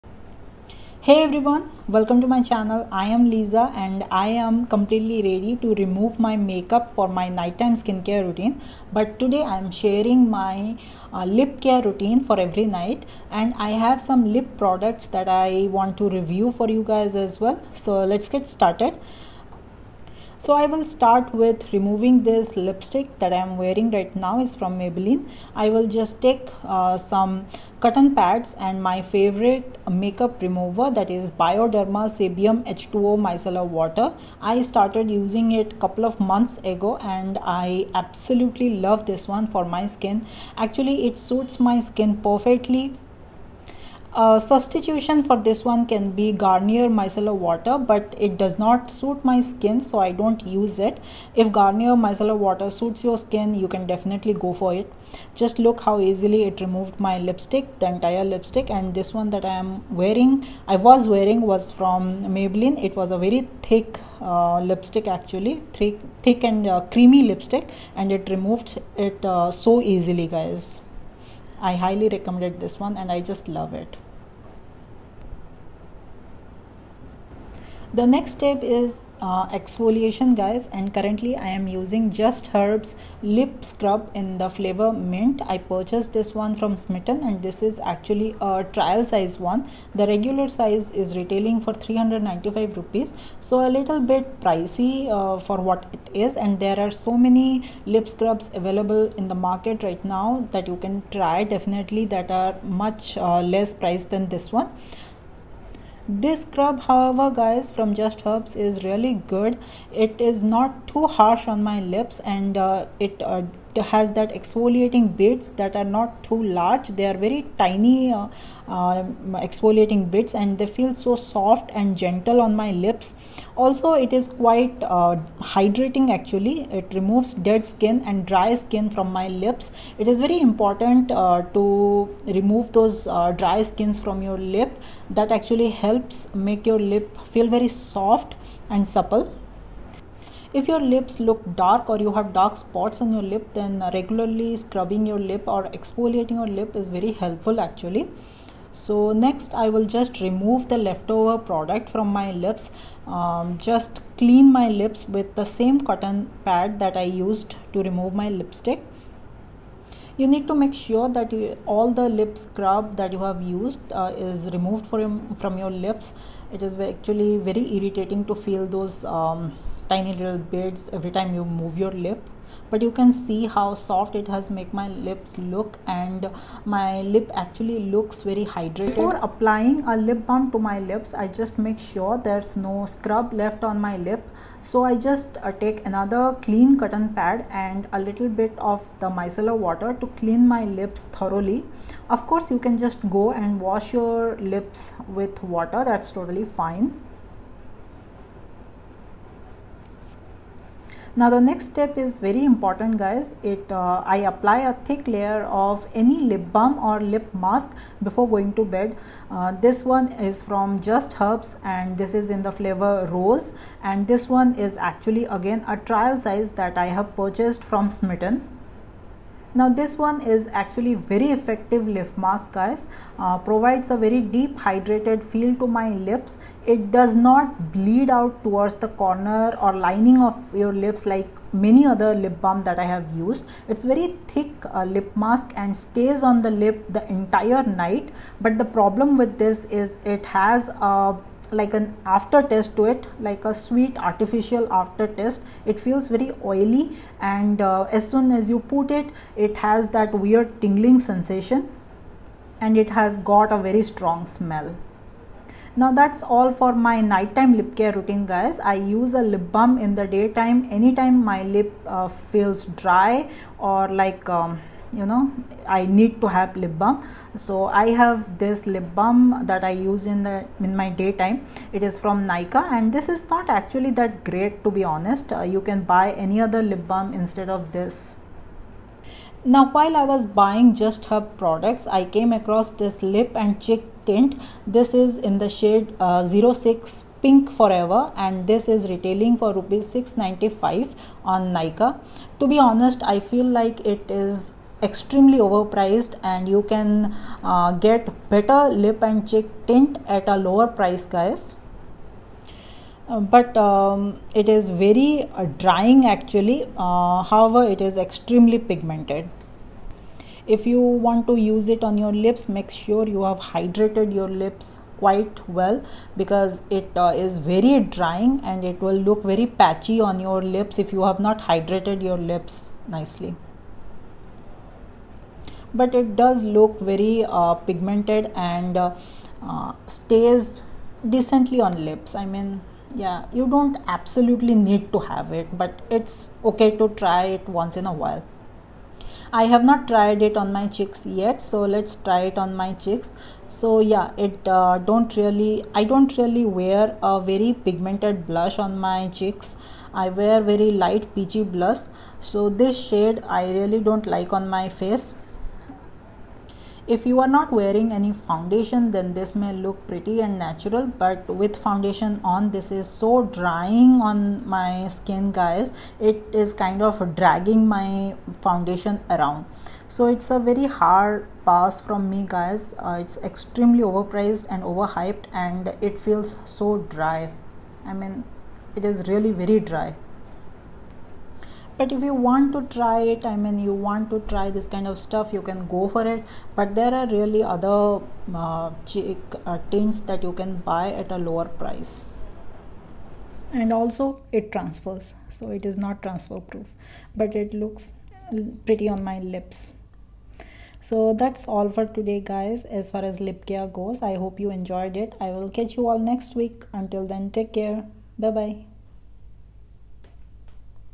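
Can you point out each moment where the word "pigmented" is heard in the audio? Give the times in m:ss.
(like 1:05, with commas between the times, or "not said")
5:08, 5:27, 5:47.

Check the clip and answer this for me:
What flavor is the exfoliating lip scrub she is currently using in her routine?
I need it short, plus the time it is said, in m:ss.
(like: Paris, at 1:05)
mint, at 1:24.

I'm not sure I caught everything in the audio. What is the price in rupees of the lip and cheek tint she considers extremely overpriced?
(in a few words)
695 rupees.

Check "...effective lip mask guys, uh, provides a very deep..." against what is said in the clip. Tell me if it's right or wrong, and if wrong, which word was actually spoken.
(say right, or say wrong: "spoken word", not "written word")
right.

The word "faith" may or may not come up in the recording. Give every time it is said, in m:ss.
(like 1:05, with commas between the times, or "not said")
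not said.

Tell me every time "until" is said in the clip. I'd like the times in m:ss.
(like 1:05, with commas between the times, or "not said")
6:46.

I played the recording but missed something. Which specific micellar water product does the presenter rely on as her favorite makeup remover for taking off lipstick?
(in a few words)
Bioderma Sébium H2O.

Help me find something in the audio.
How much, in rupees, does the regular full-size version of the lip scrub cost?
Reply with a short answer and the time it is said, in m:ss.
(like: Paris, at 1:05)
395 rupees, at 1:31.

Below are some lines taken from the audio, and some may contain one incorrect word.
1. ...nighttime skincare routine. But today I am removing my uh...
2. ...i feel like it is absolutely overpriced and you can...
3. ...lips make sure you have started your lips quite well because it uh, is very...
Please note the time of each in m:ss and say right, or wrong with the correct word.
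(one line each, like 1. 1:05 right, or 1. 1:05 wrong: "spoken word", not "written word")
1. 0:07 wrong: "sharing", not "removing"
2. 4:53 wrong: "extremely", not "absolutely"
3. 5:12 wrong: "hydrated", not "started".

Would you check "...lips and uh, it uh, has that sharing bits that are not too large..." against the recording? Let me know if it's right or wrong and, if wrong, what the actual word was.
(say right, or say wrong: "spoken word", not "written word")
wrong: "exfoliating", not "sharing".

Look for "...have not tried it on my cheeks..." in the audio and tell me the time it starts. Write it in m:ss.
5:39.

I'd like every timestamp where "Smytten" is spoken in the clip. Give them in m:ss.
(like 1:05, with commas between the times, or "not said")
1:26, 3:37.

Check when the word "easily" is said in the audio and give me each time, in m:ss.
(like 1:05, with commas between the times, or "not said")
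0:55, 1:09.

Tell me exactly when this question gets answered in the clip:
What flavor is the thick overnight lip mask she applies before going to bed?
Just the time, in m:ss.
3:32.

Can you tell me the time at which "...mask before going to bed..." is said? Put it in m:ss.
3:27.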